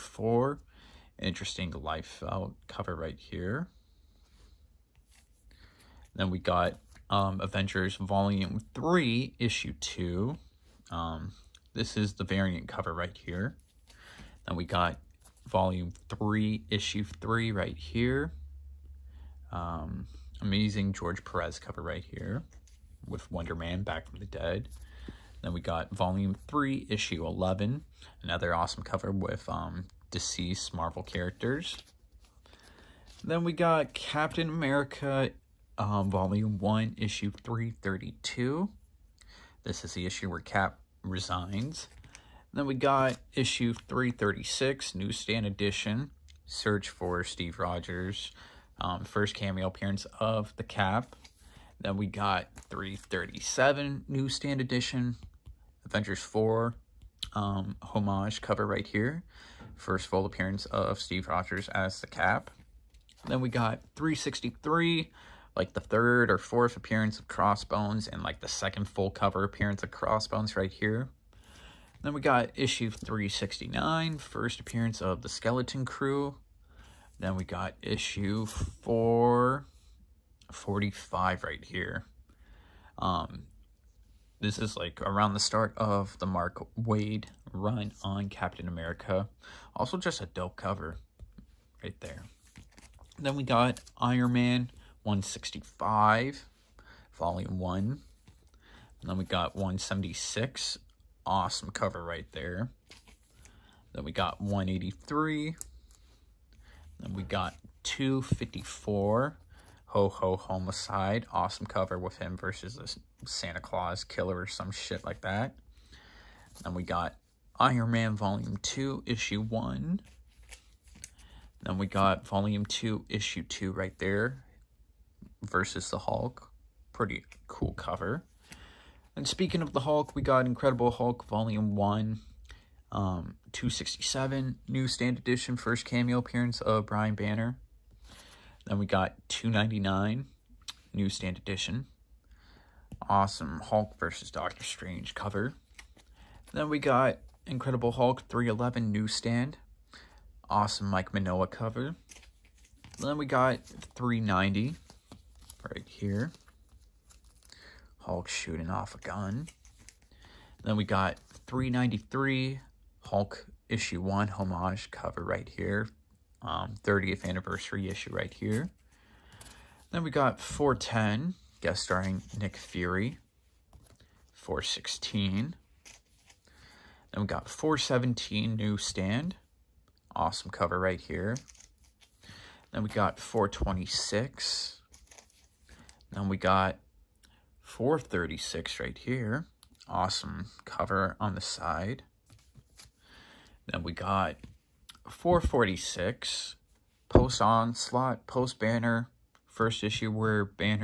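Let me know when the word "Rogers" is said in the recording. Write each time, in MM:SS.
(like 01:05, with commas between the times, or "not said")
00:47, 01:01.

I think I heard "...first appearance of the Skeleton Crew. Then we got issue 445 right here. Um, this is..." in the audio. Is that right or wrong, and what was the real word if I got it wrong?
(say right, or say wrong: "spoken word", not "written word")
right.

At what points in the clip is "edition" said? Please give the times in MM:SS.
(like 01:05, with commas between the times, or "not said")
00:45, 00:54, 02:15, 02:21.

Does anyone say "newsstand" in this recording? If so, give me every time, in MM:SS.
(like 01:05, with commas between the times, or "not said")
00:44, 00:54, 02:20, 02:28.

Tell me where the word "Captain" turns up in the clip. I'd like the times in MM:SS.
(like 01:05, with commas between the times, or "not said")
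00:33, 01:28.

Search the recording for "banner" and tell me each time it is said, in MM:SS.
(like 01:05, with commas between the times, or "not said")
02:17, 03:18.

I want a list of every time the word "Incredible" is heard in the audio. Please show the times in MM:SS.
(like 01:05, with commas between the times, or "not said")
02:10, 02:27.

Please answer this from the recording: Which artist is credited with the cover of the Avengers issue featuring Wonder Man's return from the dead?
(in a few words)
George Perez.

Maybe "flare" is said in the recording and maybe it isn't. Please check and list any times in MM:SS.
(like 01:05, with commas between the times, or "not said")
not said.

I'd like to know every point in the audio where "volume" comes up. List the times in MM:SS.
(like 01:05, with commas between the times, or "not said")
00:07, 00:15, 00:25, 00:36, 01:37, 01:58, 02:02, 02:11.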